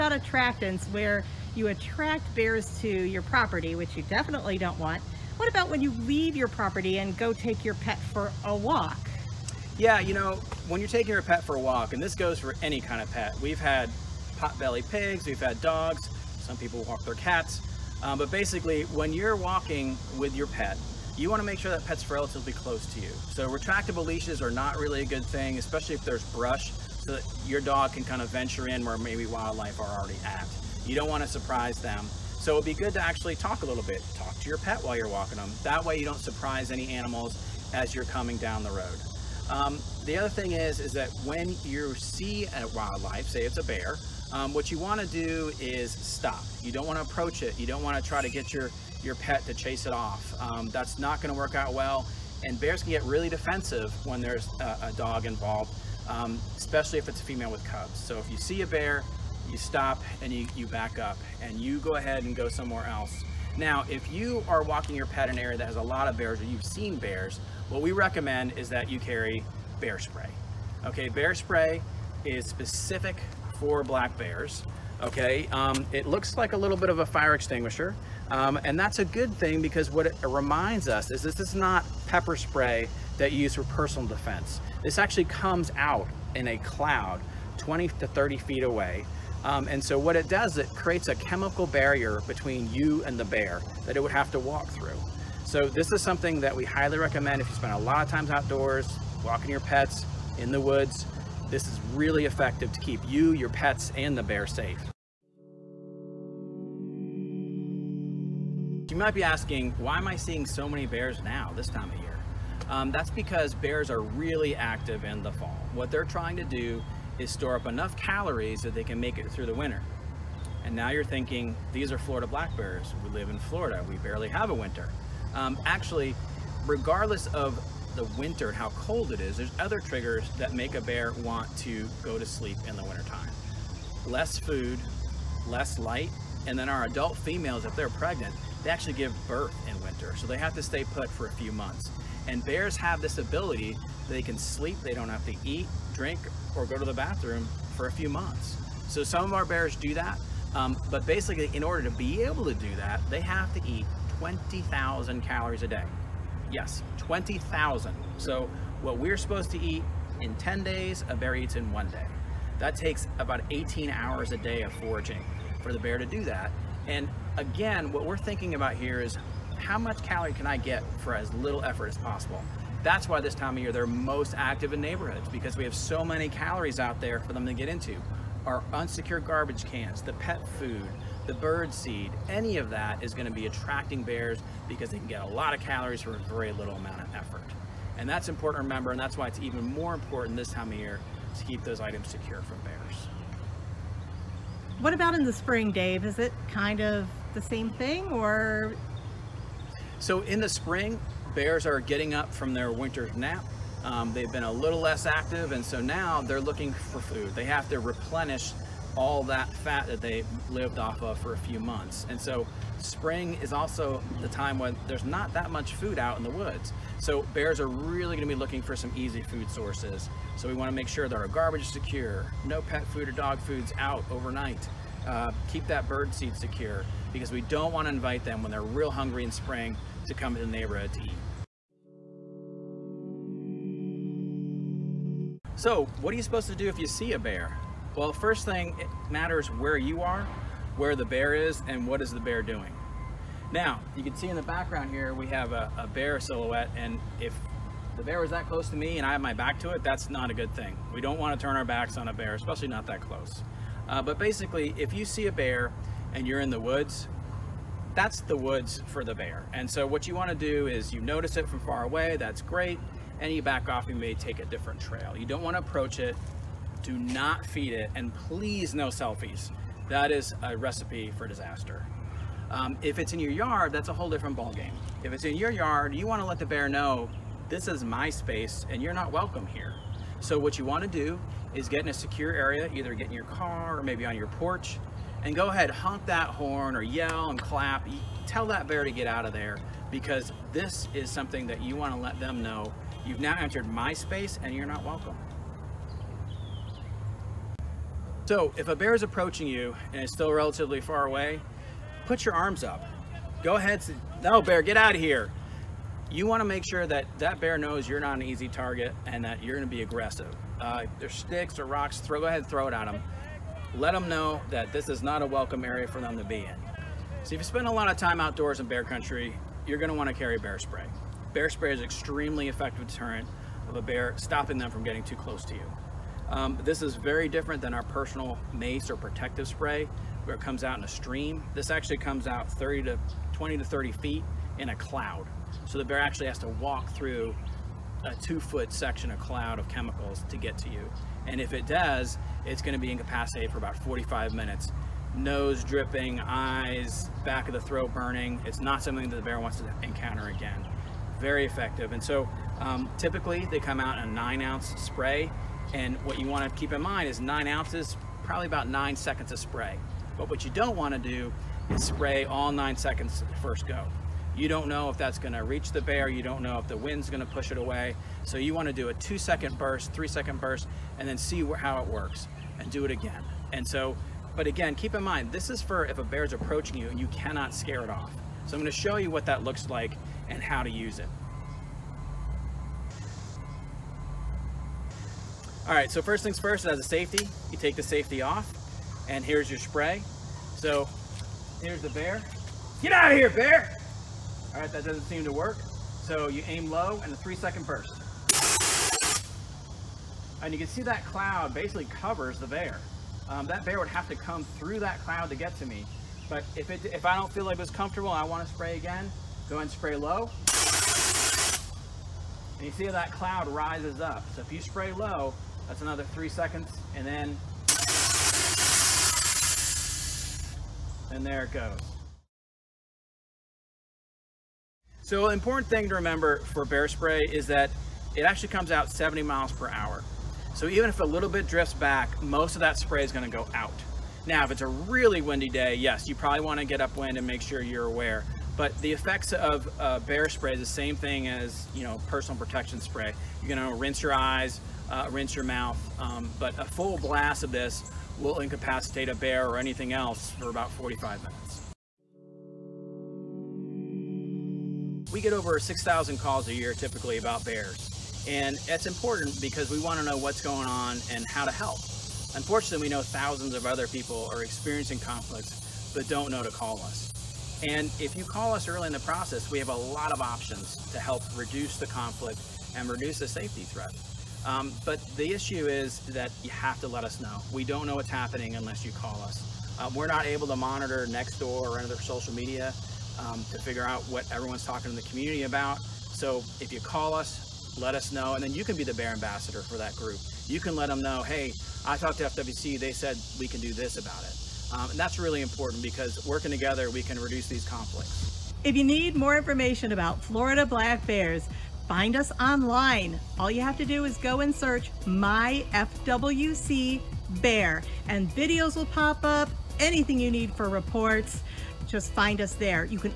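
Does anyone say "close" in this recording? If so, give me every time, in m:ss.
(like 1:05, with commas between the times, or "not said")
0:22, 4:08, 4:12, 5:25.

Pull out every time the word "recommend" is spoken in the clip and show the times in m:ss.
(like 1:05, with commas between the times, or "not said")
1:07, 1:36.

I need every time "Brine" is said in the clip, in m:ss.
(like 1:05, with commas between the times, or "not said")
not said.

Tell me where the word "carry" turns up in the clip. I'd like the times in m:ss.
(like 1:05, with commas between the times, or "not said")
1:08, 5:20.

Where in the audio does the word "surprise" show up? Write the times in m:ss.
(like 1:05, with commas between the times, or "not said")
0:31, 0:36.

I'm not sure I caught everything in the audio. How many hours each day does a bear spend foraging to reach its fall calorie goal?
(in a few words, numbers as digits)
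18.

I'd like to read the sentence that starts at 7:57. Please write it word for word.
We don't know what's happening unless you call us.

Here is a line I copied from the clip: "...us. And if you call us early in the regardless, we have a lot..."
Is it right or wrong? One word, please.
wrong.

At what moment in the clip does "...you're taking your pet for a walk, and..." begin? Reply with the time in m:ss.
0:10.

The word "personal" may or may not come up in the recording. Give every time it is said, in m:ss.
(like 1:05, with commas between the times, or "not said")
1:23, 5:27, 7:22.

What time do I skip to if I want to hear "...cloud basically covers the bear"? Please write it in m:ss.
6:41.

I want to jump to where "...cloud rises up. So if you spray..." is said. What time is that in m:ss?
6:53.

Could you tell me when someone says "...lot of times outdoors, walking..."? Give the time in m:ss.
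1:37.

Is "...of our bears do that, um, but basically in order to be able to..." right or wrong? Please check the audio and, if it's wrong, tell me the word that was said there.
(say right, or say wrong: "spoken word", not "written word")
right.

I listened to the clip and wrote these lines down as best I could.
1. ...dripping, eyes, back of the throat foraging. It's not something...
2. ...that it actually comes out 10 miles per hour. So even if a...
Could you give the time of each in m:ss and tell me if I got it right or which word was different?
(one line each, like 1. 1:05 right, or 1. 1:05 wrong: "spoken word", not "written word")
1. 5:45 wrong: "burning", not "foraging"
2. 7:07 wrong: "70", not "10".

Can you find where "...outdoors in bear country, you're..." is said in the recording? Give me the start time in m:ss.
5:18.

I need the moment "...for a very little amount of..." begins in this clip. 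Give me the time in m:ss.
3:06.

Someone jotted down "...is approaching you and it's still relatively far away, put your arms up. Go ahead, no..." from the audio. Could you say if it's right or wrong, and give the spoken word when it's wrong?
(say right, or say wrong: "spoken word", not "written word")
right.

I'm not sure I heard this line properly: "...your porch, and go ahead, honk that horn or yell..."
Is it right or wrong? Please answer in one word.
right.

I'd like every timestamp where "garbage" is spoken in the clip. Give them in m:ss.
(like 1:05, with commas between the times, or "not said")
2:59, 3:41.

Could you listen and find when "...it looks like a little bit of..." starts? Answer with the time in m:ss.
1:15.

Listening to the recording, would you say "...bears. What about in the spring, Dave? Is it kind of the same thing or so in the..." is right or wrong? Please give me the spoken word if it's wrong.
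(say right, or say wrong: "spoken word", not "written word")
right.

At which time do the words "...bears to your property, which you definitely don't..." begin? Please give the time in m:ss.
0:02.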